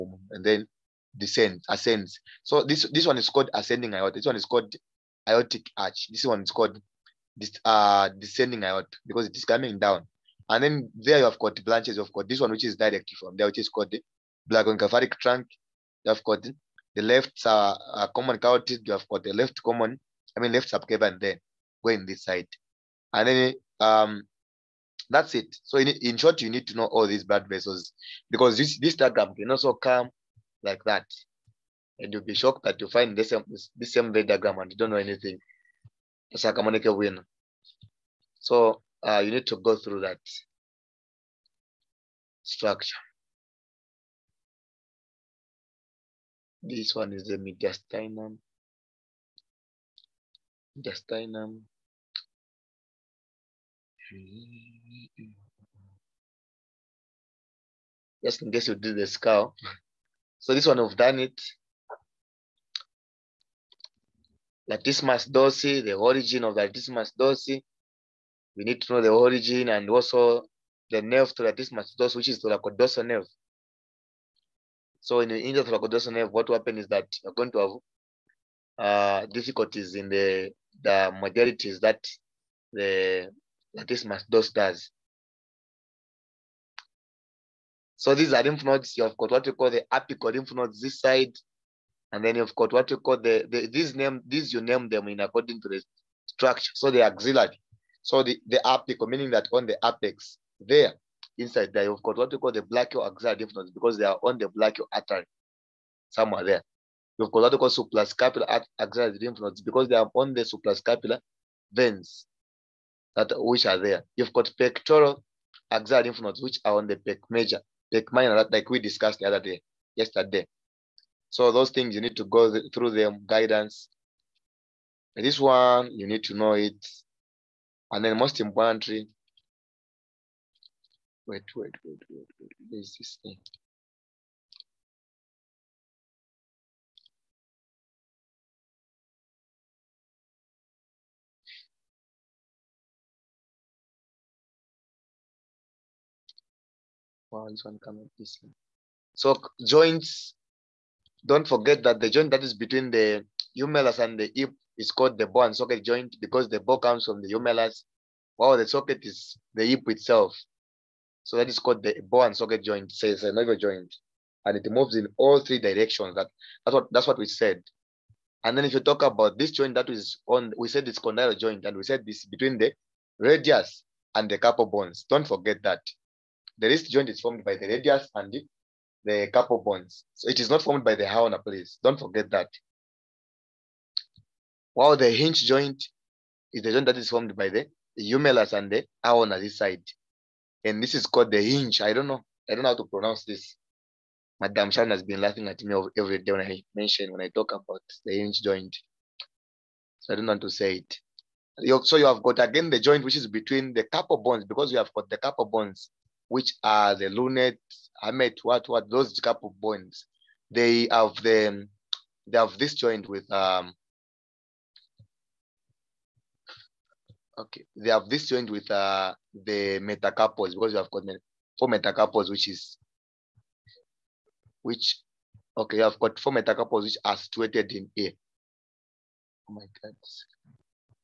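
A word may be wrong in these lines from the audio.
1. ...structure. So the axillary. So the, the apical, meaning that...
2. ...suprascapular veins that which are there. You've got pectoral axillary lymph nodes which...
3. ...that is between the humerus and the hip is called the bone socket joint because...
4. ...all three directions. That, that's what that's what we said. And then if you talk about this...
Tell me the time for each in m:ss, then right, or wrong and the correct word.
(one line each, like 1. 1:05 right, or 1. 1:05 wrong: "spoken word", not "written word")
1. 1:36 right
2. 1:50 right
3. 2:32 right
4. 2:45 right.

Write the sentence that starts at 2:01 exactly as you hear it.
So those things you need to go th through them, guidance.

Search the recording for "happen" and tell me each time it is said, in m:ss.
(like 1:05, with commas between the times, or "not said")
1:16.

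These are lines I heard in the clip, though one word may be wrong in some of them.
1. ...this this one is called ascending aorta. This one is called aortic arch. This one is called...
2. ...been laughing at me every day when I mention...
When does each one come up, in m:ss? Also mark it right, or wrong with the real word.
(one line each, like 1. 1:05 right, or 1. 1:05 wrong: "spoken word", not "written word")
1. 0:02 right
2. 3:15 right.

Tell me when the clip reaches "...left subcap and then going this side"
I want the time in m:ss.
0:20.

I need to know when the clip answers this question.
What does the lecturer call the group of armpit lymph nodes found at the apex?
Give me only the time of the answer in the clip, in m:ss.
1:29.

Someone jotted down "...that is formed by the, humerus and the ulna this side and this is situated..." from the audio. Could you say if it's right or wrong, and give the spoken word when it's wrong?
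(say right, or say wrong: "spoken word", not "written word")
wrong: "called", not "situated".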